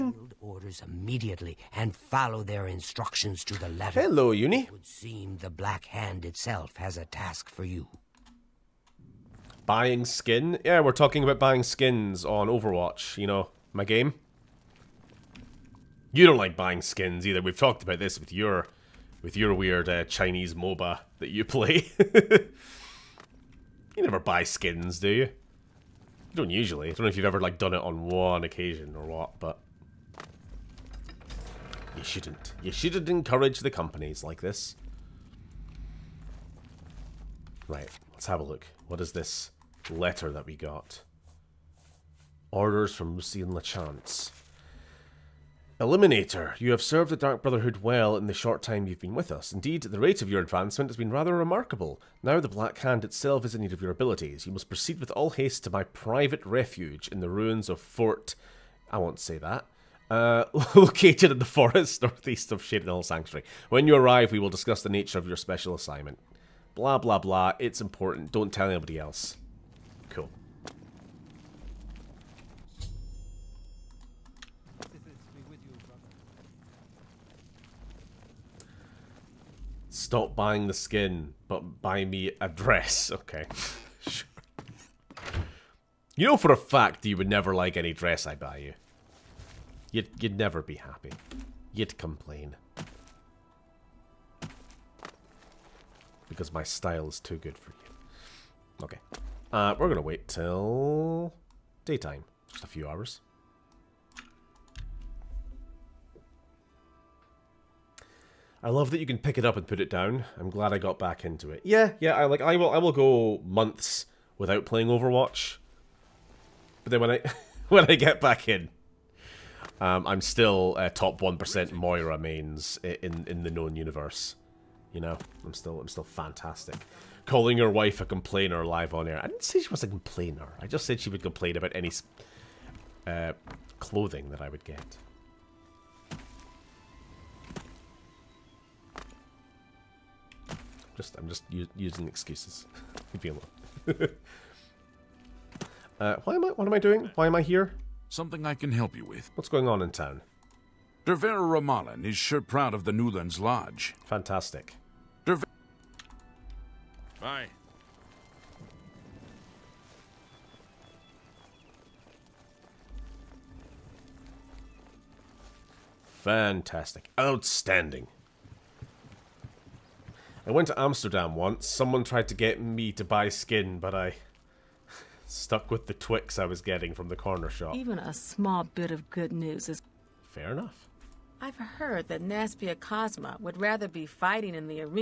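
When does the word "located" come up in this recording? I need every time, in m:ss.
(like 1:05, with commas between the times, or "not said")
1:00.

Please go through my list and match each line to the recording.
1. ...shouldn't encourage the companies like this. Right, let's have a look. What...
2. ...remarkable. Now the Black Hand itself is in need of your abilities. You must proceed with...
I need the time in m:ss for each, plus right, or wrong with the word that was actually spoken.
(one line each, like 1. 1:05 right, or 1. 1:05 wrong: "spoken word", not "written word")
1. 0:32 right
2. 0:51 right.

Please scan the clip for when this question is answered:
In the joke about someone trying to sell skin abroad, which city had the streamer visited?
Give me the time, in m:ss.
2:50.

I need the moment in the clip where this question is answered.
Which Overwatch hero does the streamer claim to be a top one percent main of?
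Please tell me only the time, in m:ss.
2:01.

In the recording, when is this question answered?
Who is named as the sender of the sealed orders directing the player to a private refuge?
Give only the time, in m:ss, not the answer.
0:43.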